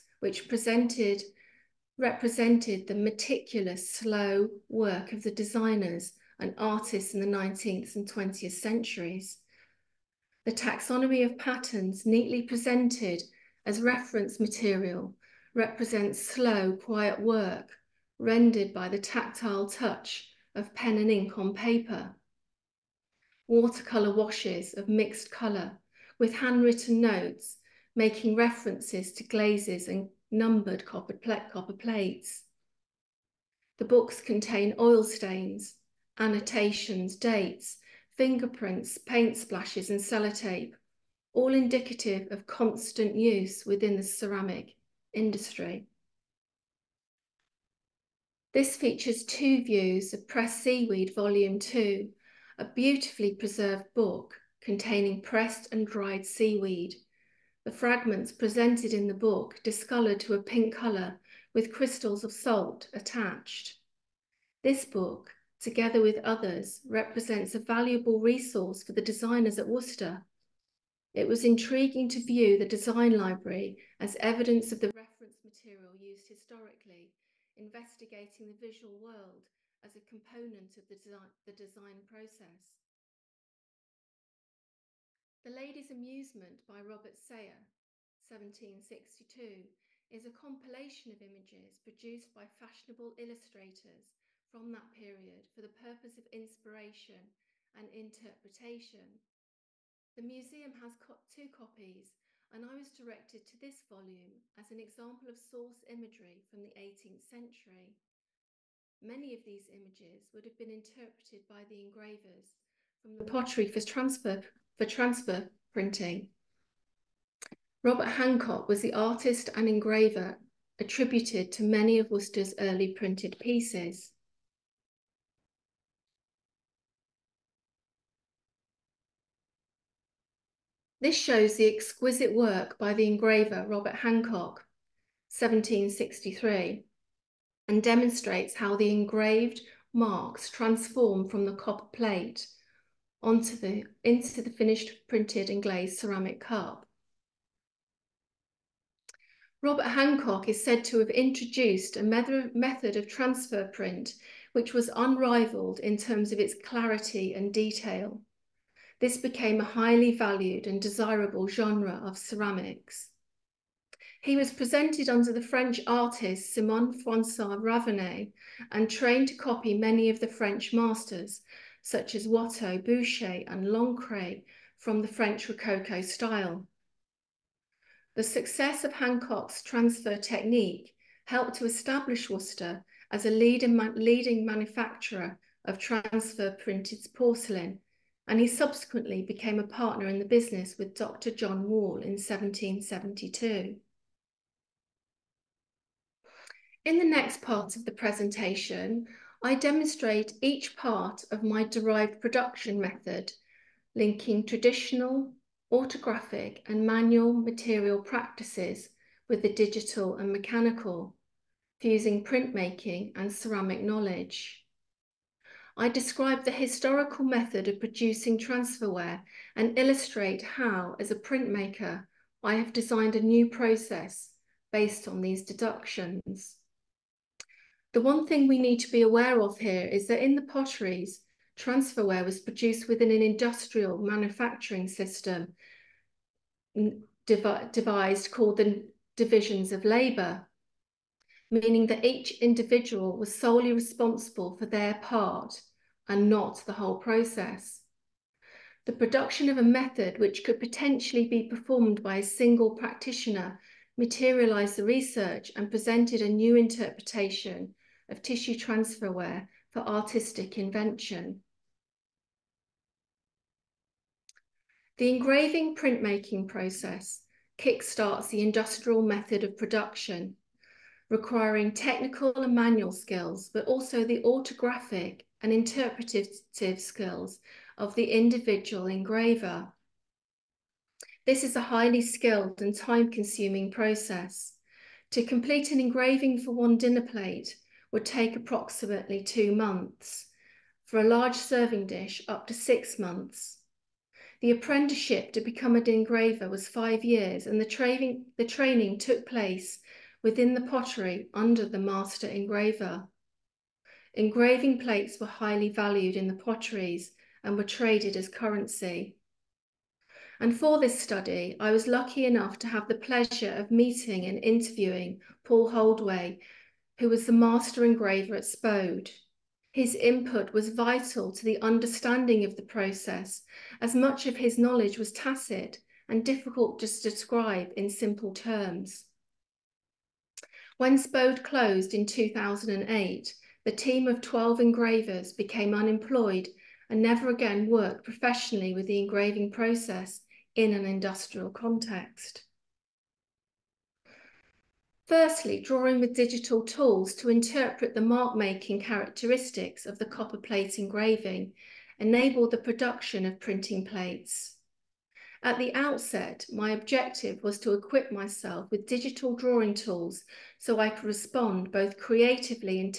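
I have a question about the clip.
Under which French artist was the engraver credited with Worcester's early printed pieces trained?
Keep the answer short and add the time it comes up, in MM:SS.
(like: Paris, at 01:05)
Simon François Ravenet, at 02:46.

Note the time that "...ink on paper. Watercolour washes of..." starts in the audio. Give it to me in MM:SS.
00:21.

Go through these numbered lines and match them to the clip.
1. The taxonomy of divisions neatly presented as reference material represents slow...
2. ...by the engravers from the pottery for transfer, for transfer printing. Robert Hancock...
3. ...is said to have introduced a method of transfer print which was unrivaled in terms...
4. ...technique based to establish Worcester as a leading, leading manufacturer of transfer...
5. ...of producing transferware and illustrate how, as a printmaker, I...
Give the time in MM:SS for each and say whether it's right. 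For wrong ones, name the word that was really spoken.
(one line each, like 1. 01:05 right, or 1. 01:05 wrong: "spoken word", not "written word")
1. 00:10 wrong: "patterns", not "divisions"
2. 01:51 right
3. 02:30 right
4. 03:00 wrong: "helped", not "based"
5. 03:37 right.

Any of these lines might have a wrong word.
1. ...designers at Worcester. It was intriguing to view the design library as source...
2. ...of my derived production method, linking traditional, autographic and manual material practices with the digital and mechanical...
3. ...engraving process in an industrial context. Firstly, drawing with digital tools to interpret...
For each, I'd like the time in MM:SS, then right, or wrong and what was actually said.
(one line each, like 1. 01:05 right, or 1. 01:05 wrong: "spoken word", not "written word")
1. 01:09 wrong: "evidence", not "source"
2. 03:21 right
3. 05:38 right.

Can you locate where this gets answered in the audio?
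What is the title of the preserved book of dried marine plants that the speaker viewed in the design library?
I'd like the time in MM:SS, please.
00:50.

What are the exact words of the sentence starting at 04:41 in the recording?
This is a highly skilled and time-consuming process.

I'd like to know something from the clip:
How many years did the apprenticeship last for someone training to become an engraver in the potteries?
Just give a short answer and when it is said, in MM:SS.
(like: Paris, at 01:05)
5, at 04:56.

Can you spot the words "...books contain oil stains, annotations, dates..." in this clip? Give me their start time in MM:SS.
00:33.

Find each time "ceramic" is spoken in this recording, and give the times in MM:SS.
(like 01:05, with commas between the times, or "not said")
00:44, 02:25, 02:42, 03:33.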